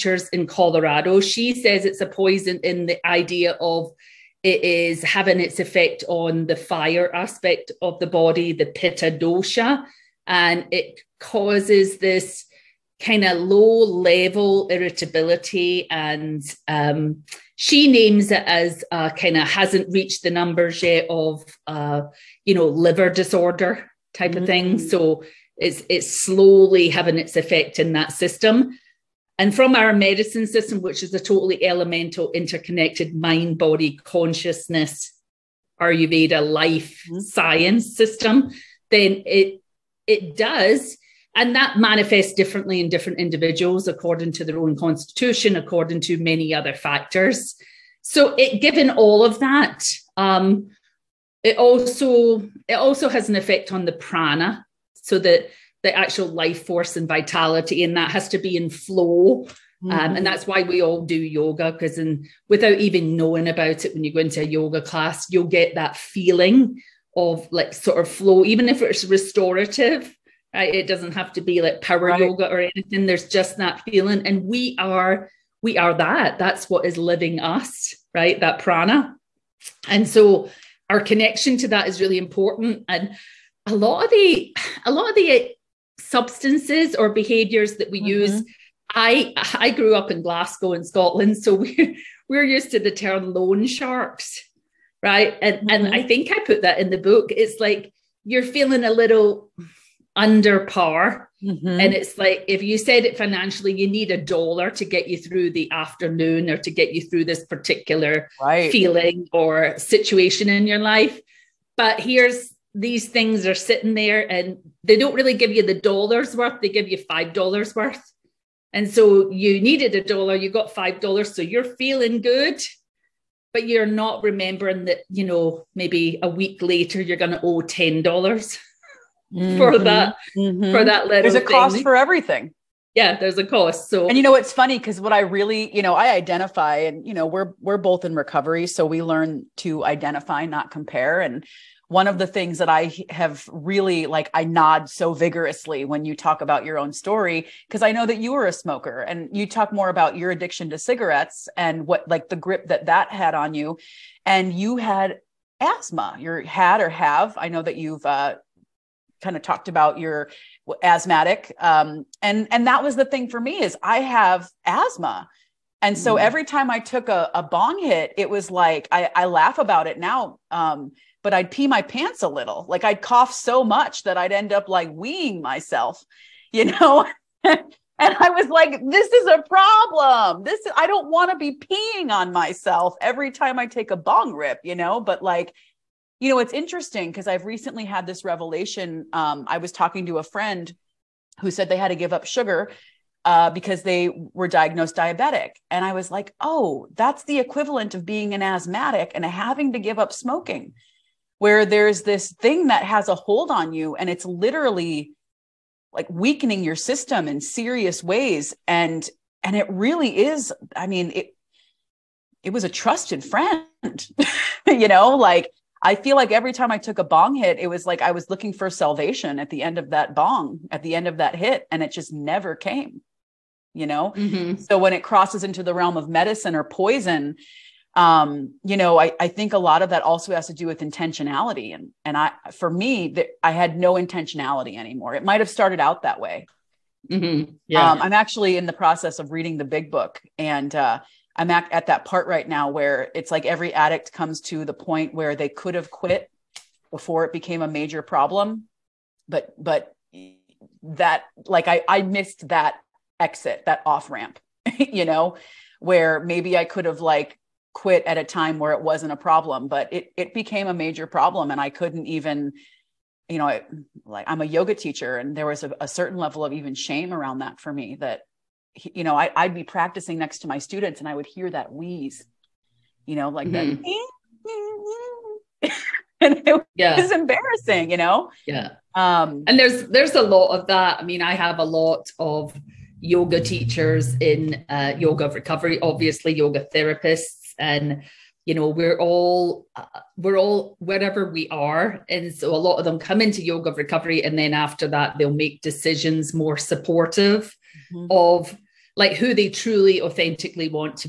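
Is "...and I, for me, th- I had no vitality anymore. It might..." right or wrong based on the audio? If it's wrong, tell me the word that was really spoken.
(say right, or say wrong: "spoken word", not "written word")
wrong: "intentionality", not "vitality".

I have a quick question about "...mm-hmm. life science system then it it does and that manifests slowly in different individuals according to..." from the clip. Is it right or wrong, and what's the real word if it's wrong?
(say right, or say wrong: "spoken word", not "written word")
wrong: "differently", not "slowly".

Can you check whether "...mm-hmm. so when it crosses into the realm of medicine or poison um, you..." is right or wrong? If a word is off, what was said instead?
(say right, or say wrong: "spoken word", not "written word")
right.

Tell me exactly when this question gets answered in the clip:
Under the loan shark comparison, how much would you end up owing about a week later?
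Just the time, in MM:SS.
02:07.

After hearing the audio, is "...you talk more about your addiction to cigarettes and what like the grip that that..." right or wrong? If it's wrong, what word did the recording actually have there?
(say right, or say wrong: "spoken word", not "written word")
right.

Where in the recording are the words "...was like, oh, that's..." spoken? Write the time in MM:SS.
03:15.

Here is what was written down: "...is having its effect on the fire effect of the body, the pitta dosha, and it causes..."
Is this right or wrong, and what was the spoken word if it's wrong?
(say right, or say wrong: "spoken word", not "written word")
wrong: "aspect", not "effect".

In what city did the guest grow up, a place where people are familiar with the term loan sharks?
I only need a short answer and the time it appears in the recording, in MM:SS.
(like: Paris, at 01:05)
Glasgow, at 01:30.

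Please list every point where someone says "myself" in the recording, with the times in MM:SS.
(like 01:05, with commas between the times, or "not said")
02:55, 03:02.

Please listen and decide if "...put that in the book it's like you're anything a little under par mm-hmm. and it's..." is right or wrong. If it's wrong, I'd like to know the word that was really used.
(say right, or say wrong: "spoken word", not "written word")
wrong: "feeling", not "anything".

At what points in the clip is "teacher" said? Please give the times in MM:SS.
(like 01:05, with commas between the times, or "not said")
04:24, 04:43.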